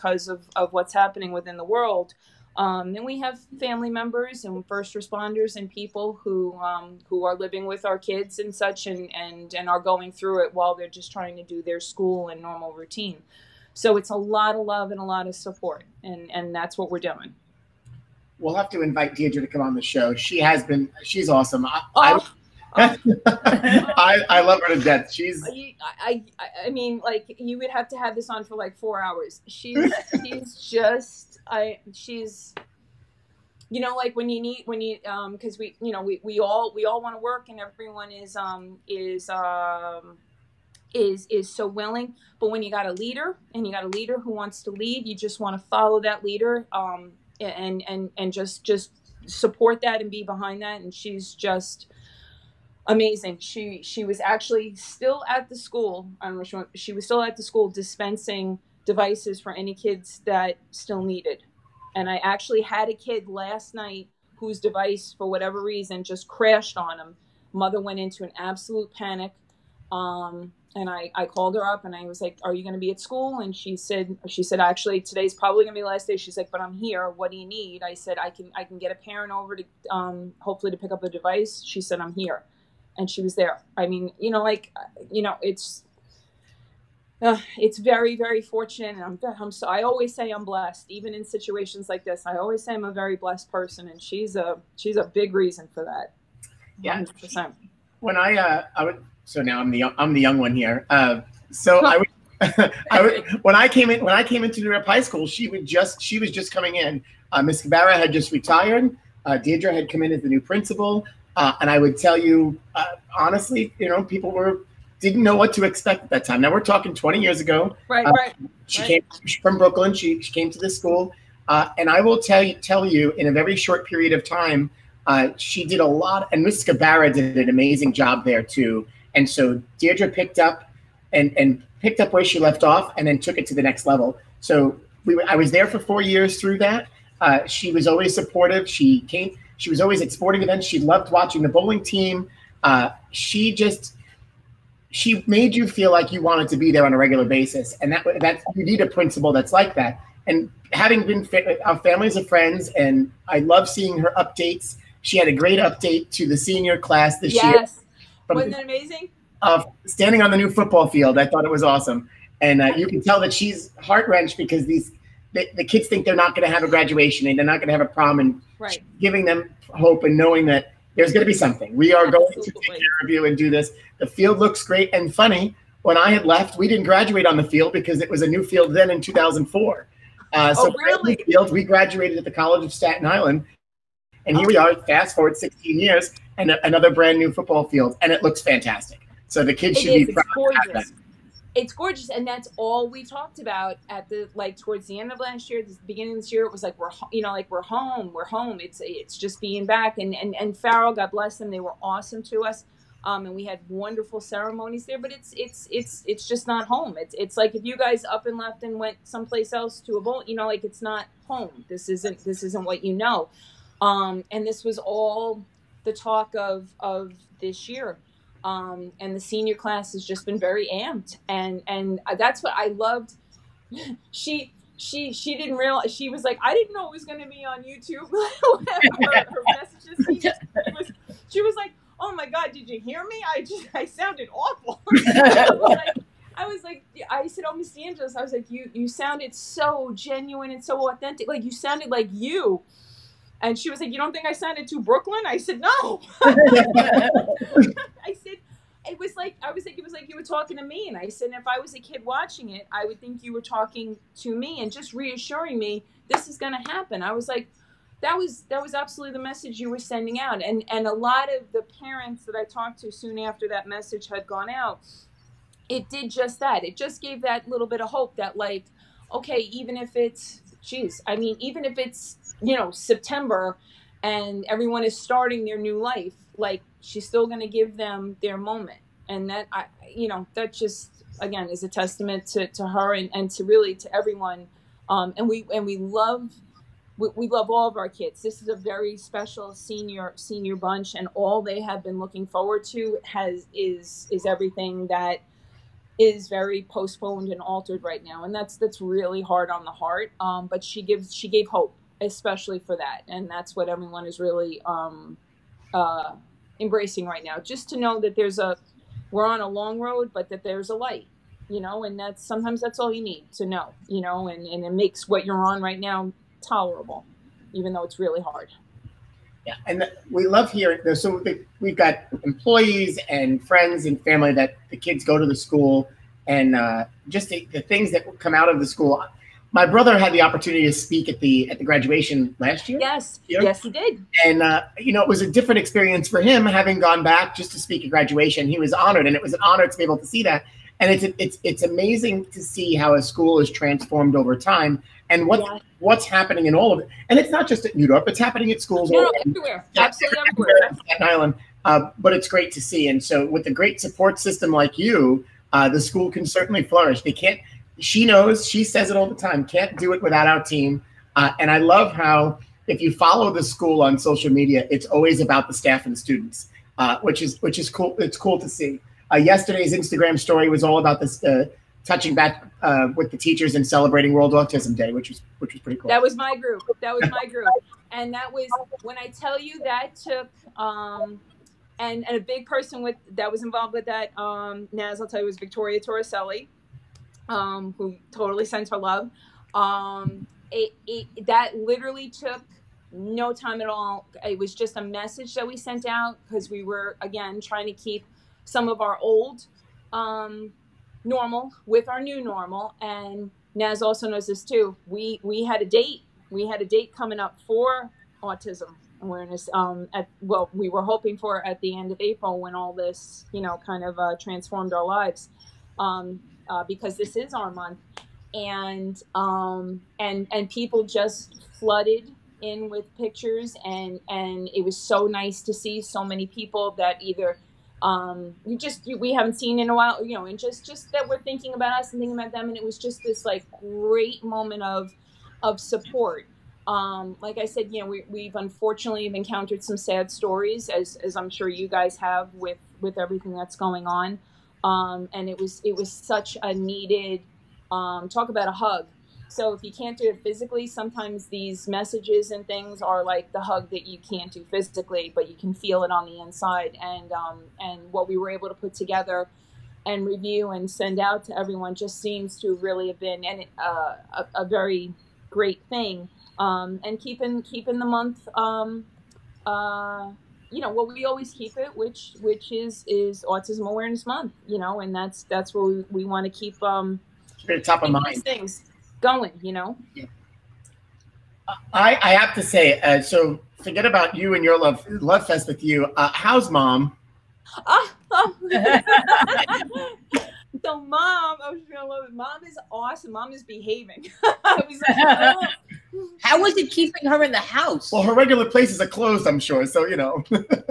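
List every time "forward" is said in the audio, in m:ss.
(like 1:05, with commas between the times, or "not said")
3:05, 4:52.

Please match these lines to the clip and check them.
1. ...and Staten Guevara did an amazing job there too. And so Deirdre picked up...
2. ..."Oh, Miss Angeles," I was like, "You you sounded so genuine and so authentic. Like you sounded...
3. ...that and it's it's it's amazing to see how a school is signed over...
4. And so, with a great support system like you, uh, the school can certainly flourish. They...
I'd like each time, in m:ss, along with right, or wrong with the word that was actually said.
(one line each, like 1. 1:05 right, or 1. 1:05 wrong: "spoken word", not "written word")
1. 2:06 wrong: "Miss", not "Staten"
2. 3:57 right
3. 5:40 wrong: "transformed", not "signed"
4. 5:52 right.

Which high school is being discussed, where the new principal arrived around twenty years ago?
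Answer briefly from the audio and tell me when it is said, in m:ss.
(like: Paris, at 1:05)
New Dorp High School, at 1:44.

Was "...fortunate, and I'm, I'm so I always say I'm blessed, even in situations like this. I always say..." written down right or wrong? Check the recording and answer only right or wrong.
right.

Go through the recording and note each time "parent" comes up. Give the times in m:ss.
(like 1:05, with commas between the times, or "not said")
1:18, 4:21.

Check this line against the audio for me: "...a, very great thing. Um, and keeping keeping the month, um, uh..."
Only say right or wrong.
right.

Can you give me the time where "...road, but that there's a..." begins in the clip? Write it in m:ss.
5:09.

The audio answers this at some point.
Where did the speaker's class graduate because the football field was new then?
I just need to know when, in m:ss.
3:02.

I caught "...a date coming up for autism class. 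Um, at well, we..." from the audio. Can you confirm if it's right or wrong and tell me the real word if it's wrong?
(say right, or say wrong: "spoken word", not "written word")
wrong: "awareness", not "class".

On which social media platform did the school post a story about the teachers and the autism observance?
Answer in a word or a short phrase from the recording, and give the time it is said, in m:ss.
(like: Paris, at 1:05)
Instagram, at 6:09.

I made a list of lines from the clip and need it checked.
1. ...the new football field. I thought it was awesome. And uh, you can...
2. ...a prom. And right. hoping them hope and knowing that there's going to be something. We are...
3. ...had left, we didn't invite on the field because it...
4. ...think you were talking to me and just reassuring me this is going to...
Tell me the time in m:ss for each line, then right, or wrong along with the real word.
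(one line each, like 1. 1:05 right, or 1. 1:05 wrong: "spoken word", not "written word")
1. 2:40 right
2. 2:47 wrong: "giving", not "hoping"
3. 2:56 wrong: "graduate", not "invite"
4. 4:13 right.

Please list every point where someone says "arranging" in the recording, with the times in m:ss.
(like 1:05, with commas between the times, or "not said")
not said.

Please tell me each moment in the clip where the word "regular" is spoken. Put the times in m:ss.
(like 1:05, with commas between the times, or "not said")
2:26, 8:18.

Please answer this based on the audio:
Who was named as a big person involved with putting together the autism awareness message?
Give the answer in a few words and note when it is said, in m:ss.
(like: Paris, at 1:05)
Victoria Torricelli, at 6:25.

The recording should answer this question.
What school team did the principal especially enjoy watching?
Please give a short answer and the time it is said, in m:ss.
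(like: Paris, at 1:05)
The bowling team, at 2:21.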